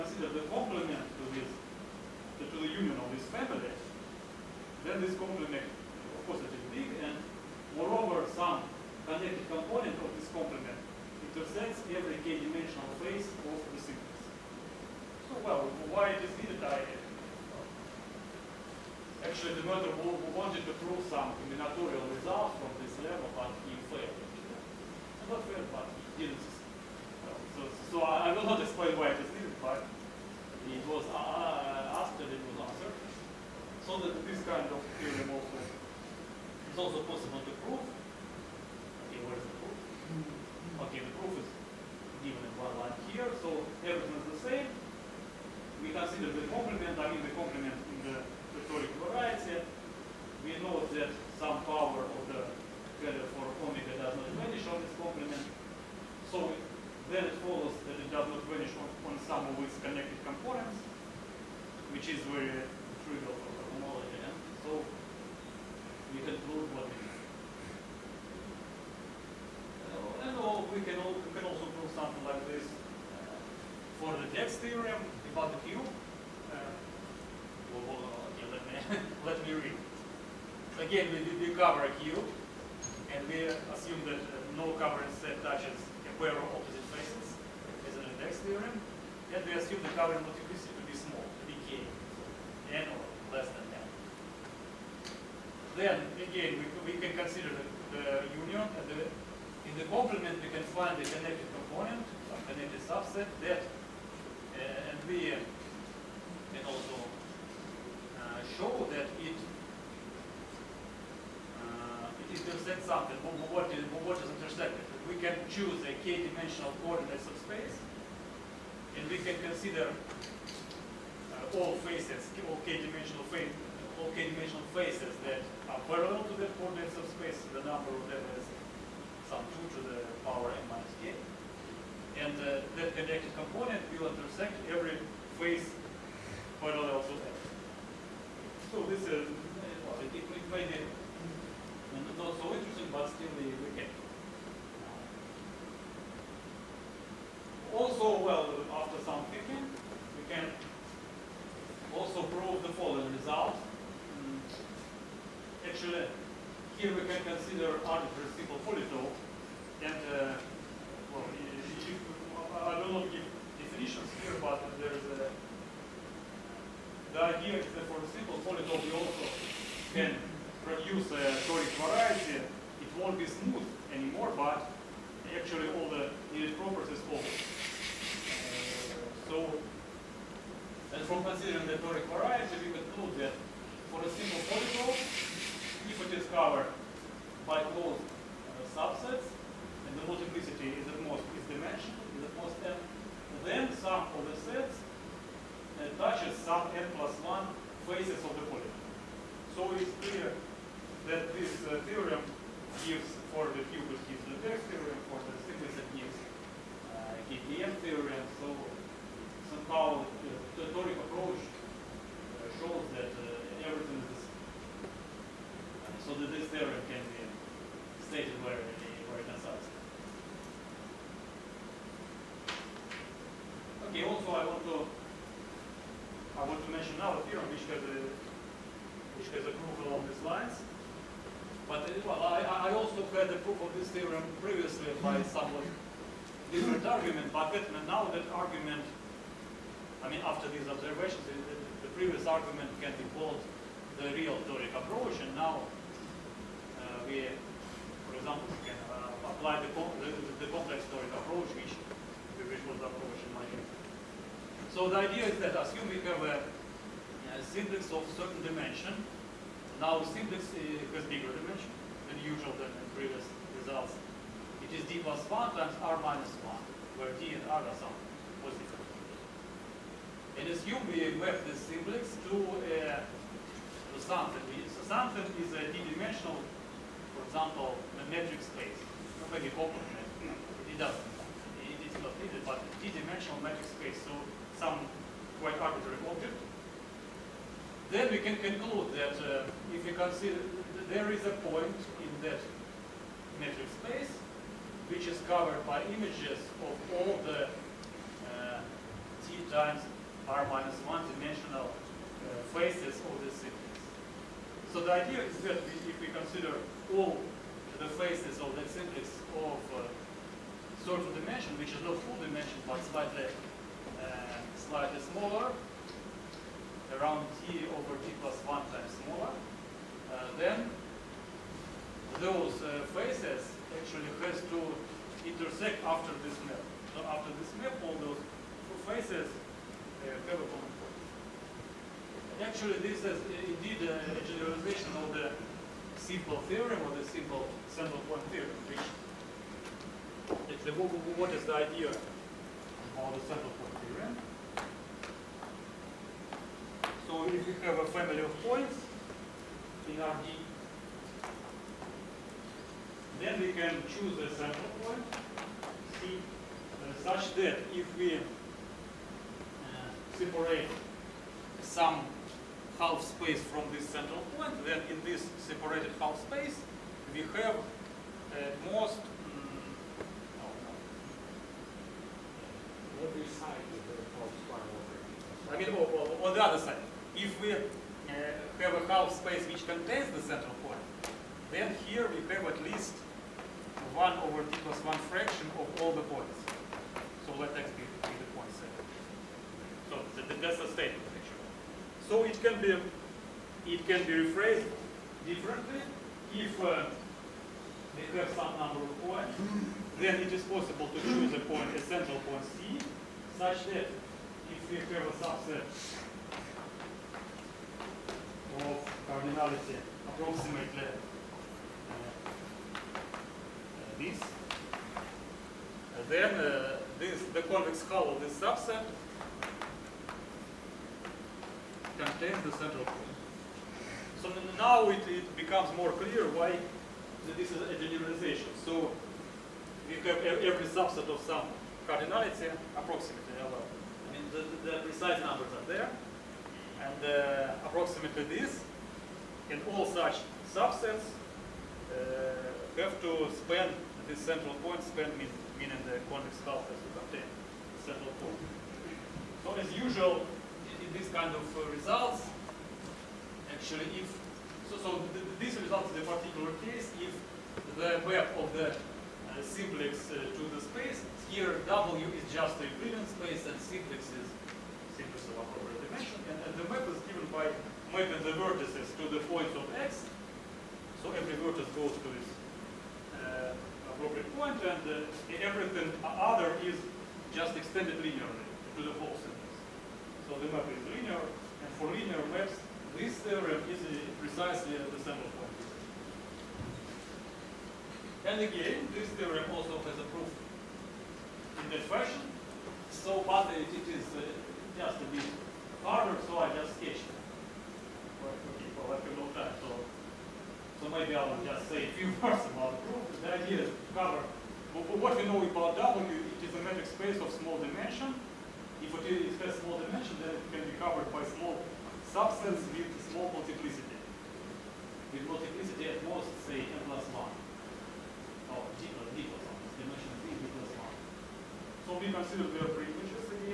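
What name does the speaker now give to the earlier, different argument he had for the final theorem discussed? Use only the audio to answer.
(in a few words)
real toric approach.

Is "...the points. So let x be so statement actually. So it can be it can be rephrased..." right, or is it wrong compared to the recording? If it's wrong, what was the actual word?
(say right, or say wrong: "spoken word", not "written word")
right.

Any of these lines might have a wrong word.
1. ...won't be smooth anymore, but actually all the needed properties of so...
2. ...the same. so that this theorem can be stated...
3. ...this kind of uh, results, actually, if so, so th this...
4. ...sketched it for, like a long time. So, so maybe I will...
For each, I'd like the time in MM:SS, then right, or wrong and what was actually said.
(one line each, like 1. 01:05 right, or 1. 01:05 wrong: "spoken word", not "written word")
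1. 02:52 right
2. 03:34 right
3. 07:30 right
4. 08:16 right.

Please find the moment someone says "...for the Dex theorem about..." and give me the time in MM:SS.
01:14.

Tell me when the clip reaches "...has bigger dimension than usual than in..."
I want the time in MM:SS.
04:20.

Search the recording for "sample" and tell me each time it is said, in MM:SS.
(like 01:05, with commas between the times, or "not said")
08:04.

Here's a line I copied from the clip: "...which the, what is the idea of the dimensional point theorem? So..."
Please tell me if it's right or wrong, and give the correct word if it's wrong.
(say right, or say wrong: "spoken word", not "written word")
wrong: "central", not "dimensional".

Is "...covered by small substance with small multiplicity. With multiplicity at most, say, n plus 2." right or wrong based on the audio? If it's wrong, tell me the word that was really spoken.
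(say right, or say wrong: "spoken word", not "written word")
wrong: "1", not "2".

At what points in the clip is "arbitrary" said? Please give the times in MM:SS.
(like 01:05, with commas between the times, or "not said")
02:37, 04:45.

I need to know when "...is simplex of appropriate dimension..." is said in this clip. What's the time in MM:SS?
07:44.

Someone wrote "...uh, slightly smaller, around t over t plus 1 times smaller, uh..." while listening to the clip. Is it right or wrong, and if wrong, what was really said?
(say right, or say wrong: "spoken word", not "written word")
right.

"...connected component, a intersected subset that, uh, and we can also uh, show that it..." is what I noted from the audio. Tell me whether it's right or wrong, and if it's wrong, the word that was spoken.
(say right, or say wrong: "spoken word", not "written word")
wrong: "connected", not "intersected".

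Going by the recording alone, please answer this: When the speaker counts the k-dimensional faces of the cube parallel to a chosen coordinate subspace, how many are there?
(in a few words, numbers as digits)
2 to the power n minus k.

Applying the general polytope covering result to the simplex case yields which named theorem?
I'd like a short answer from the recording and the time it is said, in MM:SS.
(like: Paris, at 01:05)
KKM theorem, at 03:27.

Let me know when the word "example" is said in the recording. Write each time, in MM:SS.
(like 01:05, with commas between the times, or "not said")
04:08, 04:37.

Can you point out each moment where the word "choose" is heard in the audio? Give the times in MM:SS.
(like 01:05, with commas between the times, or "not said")
01:55, 05:53, 06:41.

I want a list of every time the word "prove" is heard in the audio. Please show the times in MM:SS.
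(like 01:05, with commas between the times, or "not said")
01:06, 01:11, 02:32.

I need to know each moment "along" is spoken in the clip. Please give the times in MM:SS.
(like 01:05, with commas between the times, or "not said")
03:49.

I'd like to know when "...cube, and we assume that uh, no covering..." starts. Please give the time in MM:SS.
01:22.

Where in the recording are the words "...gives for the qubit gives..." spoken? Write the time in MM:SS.
03:22.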